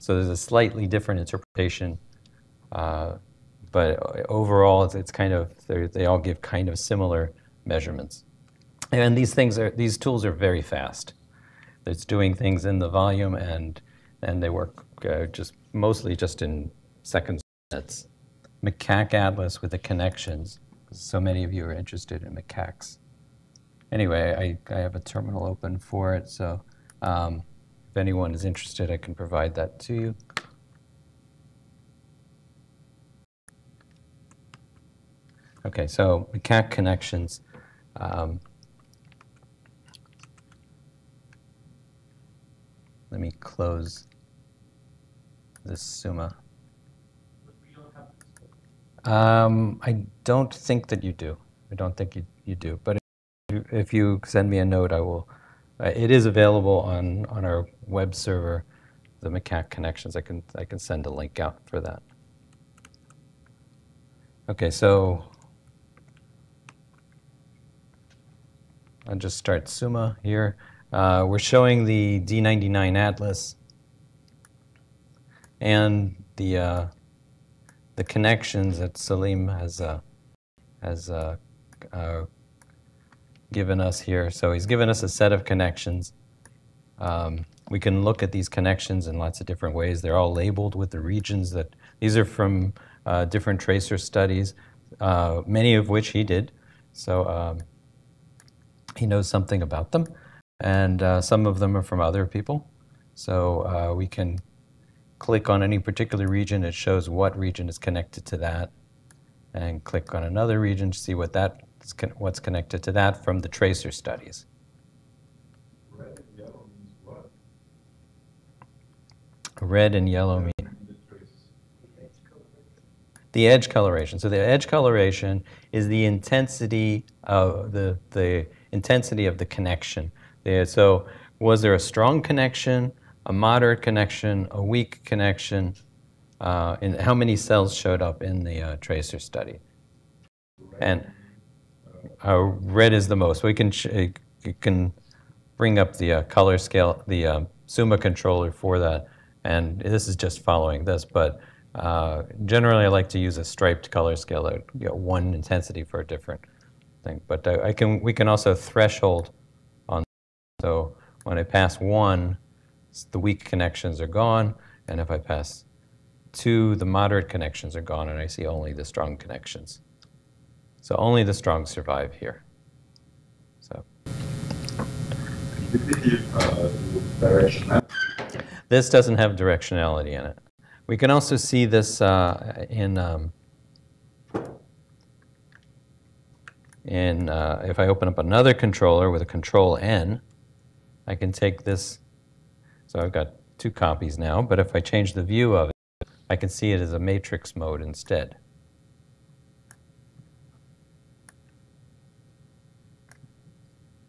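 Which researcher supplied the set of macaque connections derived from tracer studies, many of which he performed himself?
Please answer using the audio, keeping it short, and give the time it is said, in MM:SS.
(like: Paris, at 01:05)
Saleem, at 01:18.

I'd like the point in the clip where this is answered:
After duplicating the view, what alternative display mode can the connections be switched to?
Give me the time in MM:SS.
03:16.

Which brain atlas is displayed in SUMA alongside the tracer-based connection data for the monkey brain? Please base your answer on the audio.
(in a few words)
D99.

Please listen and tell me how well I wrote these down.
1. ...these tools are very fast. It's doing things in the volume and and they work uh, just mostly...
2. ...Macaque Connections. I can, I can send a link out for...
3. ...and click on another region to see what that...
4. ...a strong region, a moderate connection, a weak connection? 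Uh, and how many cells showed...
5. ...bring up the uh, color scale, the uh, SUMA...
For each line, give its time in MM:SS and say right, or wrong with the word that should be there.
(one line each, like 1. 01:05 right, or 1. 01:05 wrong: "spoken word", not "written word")
1. 00:09 right
2. 00:59 right
3. 01:49 right
4. 02:11 wrong: "connection", not "region"
5. 02:25 right.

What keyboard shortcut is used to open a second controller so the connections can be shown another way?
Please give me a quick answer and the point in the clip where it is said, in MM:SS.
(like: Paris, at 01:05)
control N, at 03:09.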